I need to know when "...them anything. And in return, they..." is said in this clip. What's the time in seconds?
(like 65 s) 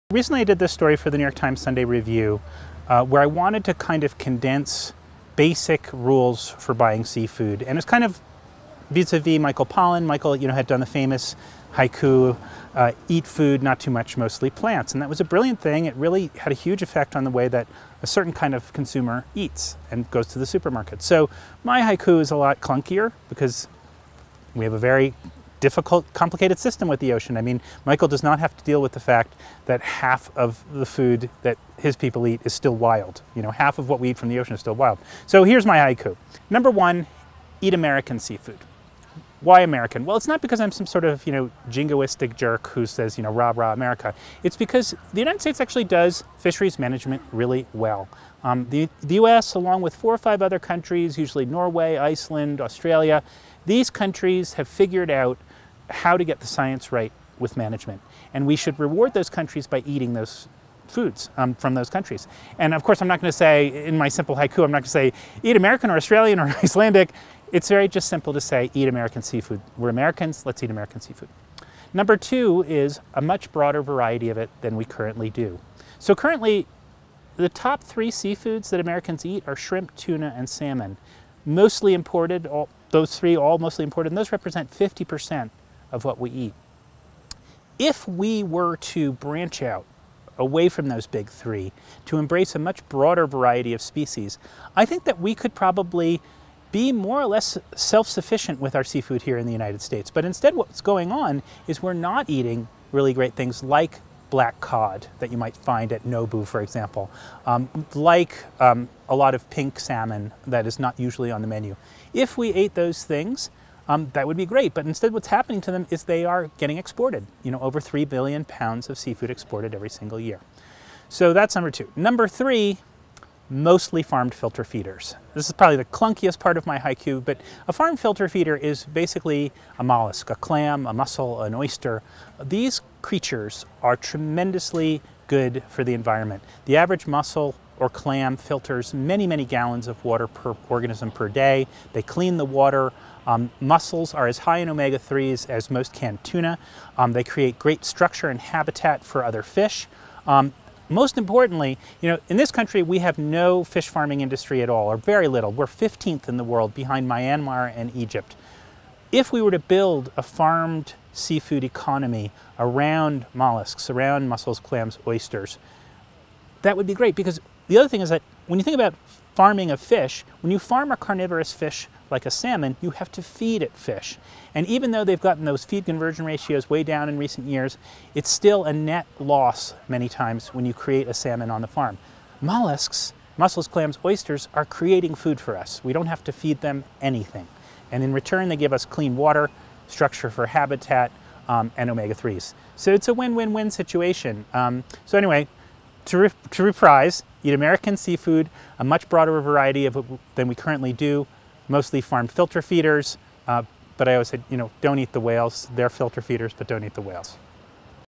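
186 s.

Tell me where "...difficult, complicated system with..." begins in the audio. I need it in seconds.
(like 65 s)
25 s.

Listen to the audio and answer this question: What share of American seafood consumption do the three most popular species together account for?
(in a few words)
50%.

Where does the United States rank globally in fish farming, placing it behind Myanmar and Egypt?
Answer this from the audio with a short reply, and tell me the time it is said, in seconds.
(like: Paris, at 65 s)
15th, at 155 s.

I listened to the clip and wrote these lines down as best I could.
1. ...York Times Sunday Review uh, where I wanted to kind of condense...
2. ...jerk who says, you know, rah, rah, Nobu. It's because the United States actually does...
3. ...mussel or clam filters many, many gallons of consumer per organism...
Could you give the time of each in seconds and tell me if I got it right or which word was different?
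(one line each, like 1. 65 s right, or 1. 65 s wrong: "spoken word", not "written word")
1. 1 s right
2. 42 s wrong: "America", not "Nobu"
3. 137 s wrong: "water", not "consumer".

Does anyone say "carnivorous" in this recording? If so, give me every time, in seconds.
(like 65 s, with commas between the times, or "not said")
170 s.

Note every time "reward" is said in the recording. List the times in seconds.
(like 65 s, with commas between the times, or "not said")
58 s.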